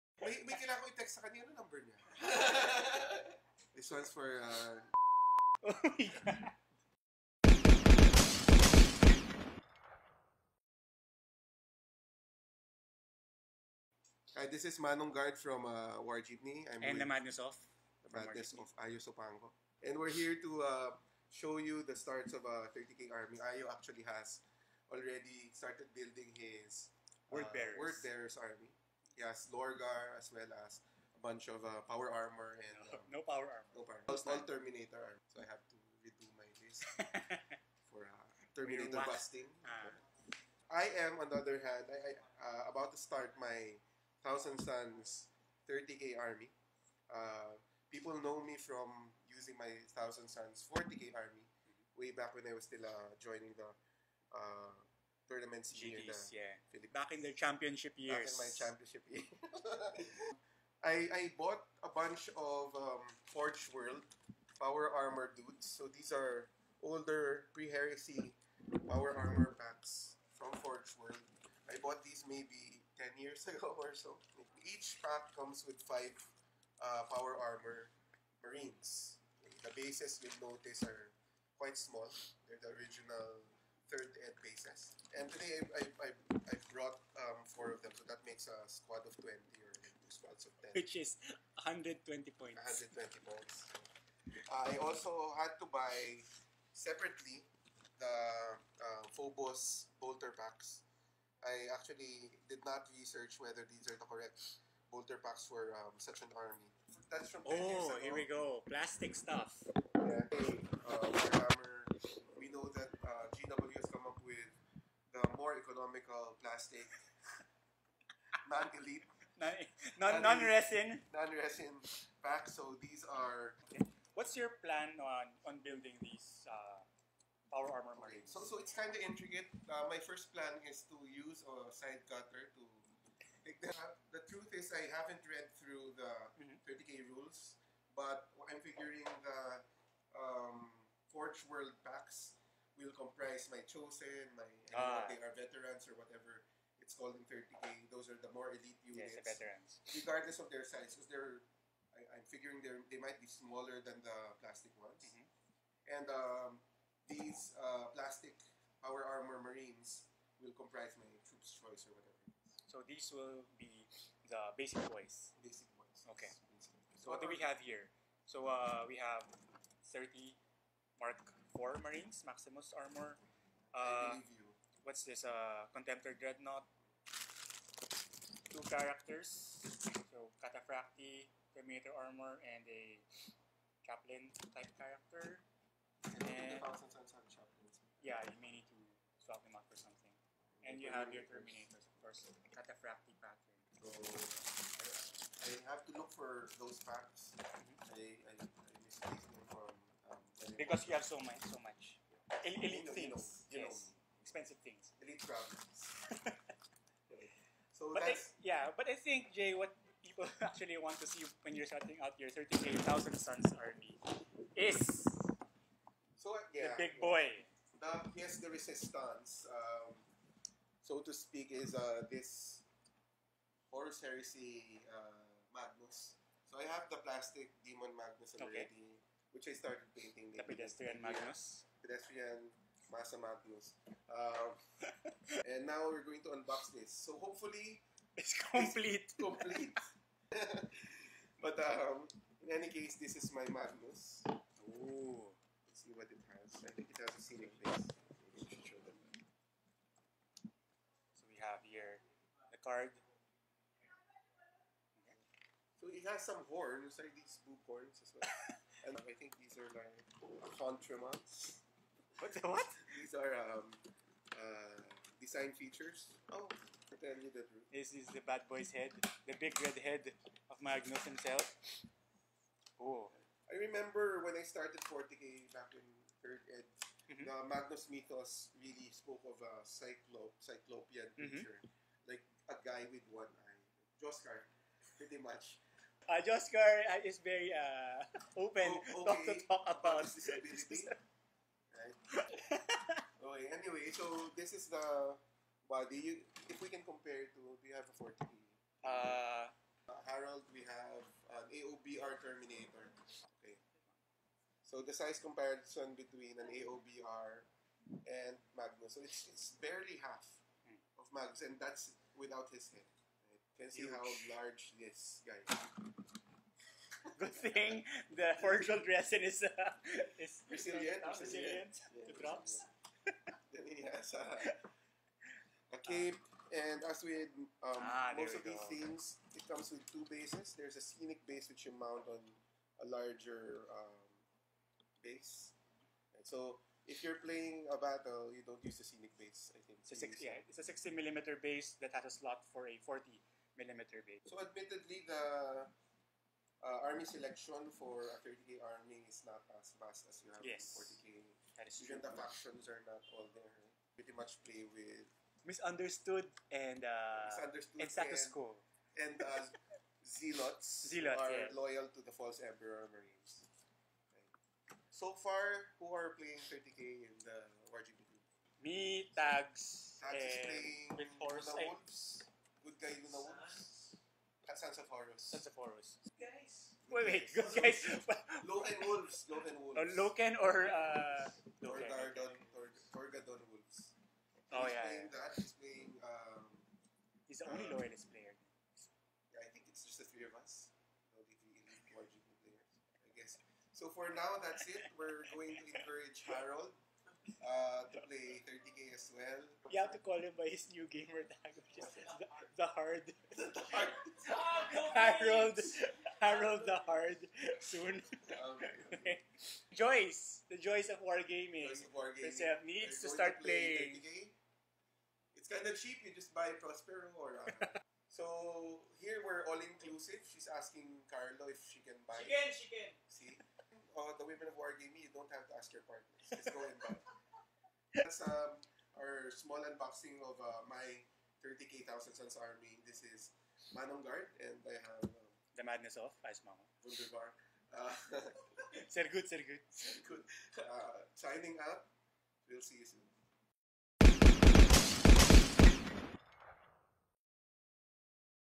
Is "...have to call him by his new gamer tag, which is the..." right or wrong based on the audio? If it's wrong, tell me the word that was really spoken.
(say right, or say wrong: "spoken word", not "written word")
right.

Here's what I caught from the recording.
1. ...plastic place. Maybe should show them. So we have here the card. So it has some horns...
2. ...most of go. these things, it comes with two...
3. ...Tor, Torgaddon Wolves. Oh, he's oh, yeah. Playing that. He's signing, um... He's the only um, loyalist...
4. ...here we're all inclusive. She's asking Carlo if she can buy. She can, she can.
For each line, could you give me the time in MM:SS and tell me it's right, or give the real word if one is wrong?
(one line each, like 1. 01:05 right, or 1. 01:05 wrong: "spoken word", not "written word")
1. 04:07 wrong: "scenic", not "plastic"
2. 05:28 right
3. 06:22 wrong: "playing", not "signing"
4. 06:58 right.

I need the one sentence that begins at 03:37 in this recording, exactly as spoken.
The, yes, the resistance, um, so to speak, is uh, this Horus Heresy uh, Magnus.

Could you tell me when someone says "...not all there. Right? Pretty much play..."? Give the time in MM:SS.
05:52.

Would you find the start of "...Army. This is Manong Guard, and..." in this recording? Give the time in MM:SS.
07:12.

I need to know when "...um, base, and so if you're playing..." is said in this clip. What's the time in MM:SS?
05:33.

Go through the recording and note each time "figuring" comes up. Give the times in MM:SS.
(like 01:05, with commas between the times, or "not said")
02:18, 02:32.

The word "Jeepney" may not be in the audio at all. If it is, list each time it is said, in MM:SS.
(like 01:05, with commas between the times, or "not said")
00:16.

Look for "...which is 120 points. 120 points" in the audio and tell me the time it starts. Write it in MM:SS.
01:30.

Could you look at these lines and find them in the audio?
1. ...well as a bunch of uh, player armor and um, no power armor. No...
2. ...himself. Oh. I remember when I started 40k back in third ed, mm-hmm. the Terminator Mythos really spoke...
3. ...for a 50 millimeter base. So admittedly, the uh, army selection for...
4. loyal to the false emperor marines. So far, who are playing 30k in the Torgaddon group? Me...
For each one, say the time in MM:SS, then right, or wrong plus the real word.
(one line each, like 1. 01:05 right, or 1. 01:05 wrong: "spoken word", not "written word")
1. 00:30 wrong: "power", not "player"
2. 04:31 wrong: "Magnus", not "Terminator"
3. 05:42 wrong: "40", not "50"
4. 06:01 wrong: "RGB", not "Torgaddon".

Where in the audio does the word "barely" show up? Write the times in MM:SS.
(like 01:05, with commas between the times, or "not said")
05:09.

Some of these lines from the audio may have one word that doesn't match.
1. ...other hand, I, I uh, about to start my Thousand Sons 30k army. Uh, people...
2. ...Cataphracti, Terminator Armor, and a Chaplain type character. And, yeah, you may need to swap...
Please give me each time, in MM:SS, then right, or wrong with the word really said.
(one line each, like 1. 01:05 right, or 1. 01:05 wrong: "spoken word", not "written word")
1. 00:41 right
2. 03:00 right.